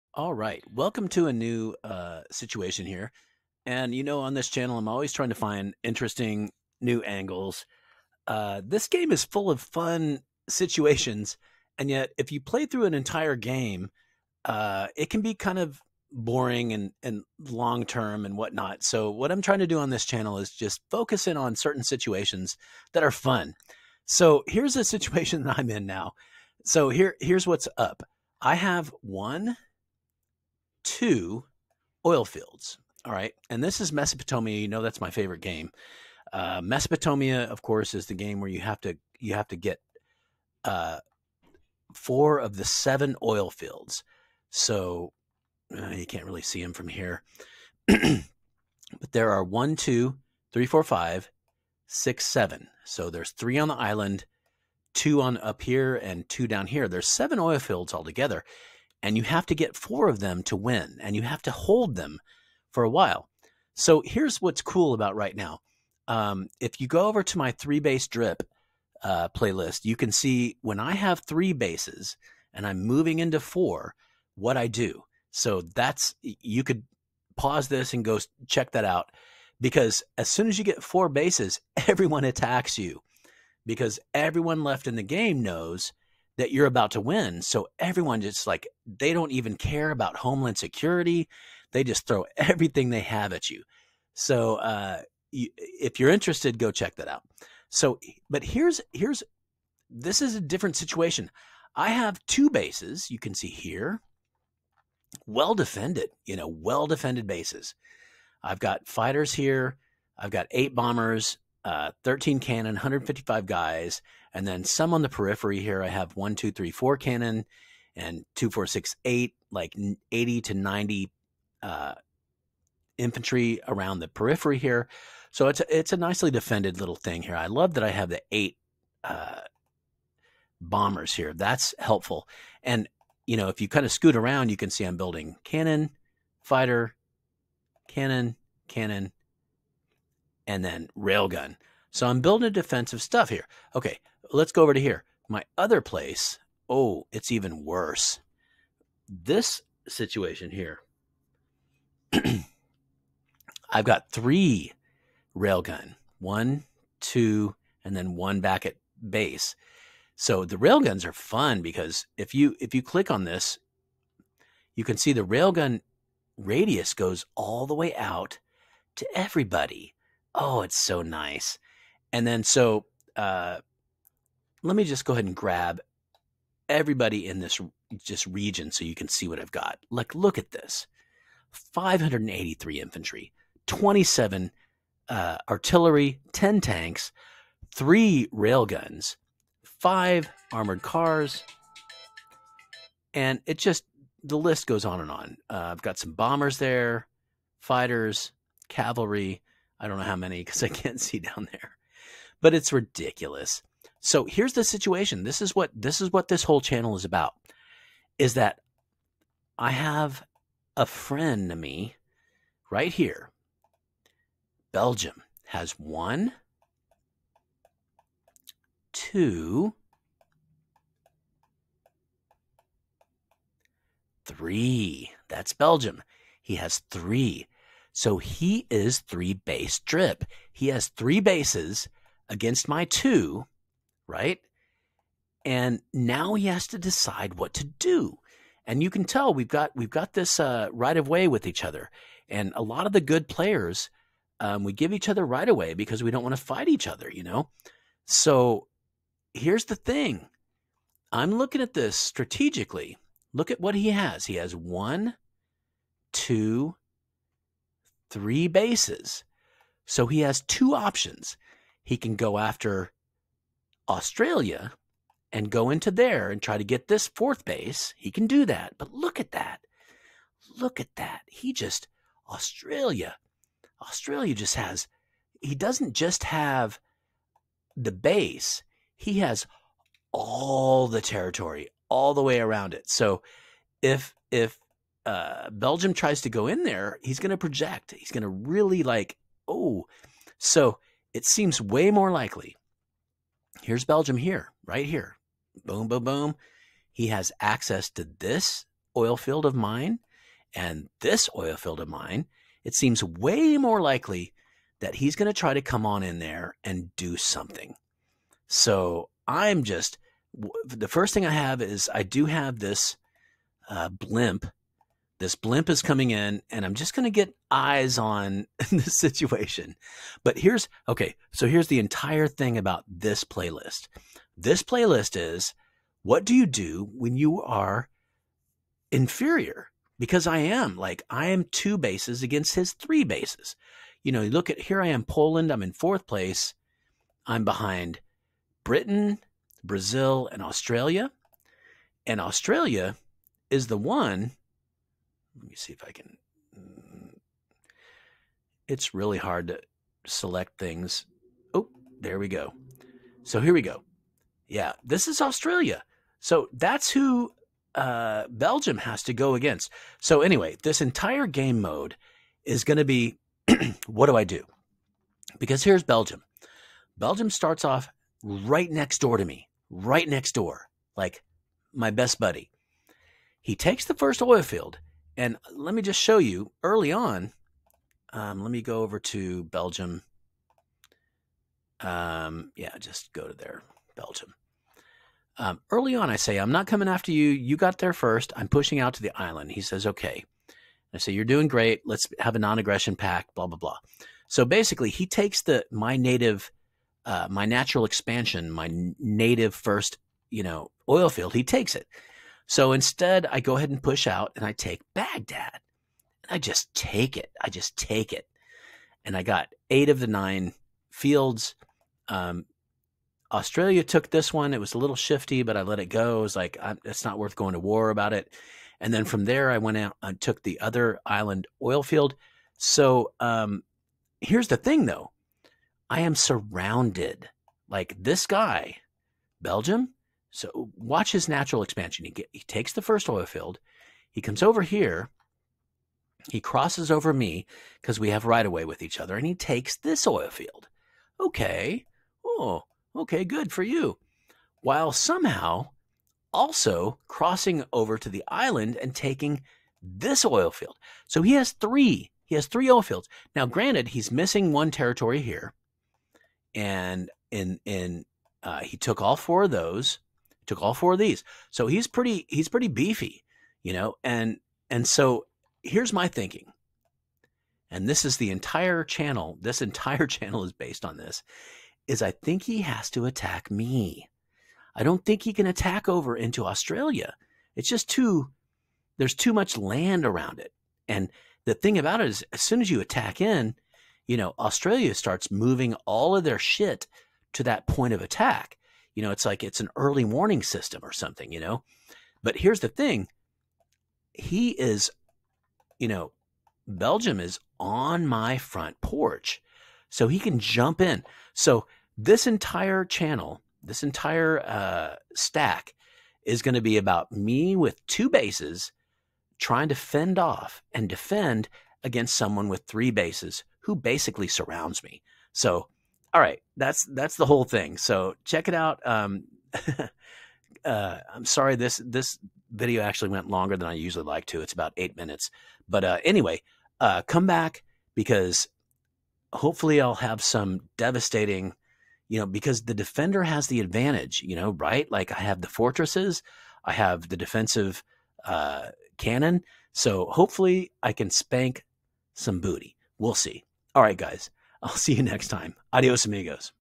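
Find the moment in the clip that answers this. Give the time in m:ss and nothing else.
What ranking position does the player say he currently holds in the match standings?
5:35.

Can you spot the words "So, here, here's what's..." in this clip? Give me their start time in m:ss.
0:26.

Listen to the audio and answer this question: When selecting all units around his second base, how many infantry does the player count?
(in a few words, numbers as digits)
583.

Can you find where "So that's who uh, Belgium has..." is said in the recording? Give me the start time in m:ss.
5:56.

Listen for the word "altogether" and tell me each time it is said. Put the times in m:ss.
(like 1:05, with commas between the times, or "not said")
0:57.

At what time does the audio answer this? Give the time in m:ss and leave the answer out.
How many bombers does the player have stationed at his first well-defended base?
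1:50.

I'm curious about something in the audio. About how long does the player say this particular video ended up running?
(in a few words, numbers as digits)
About 8 minutes.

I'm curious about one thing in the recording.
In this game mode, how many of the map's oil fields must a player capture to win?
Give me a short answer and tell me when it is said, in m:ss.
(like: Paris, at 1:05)
4, at 0:41.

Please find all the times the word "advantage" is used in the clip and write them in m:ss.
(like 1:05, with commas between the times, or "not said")
8:53.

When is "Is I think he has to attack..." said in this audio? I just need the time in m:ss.
7:51.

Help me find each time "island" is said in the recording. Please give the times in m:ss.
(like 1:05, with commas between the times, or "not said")
0:53, 6:29, 7:01, 7:28.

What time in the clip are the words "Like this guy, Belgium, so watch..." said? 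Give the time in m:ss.
7:07.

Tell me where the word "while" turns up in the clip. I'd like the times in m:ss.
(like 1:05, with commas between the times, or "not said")
1:02, 7:24.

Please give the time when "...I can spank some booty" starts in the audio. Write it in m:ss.
9:00.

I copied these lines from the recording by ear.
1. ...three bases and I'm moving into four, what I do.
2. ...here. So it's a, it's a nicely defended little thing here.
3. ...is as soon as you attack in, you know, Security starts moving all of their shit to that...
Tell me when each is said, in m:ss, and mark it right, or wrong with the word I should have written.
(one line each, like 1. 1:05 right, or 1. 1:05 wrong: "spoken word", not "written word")
1. 1:11 right
2. 2:04 right
3. 8:02 wrong: "Australia", not "Security".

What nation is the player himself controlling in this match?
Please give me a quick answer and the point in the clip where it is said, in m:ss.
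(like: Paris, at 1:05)
Poland, at 5:35.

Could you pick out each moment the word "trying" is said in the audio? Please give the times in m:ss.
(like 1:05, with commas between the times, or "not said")
0:05, 0:19, 8:29.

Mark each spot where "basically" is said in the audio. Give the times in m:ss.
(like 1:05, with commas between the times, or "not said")
6:34, 8:33.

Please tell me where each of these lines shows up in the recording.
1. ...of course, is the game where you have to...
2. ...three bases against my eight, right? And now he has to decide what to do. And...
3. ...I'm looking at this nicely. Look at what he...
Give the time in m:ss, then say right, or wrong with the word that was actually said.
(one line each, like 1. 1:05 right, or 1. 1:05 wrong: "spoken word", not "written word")
1. 0:37 right
2. 3:50 wrong: "two", not "eight"
3. 4:11 wrong: "strategically", not "nicely".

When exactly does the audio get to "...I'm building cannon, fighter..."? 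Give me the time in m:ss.
2:14.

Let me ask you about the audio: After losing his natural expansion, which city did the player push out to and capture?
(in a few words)
Baghdad.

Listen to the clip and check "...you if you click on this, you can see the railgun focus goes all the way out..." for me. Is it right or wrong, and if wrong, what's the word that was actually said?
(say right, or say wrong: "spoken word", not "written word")
wrong: "radius", not "focus".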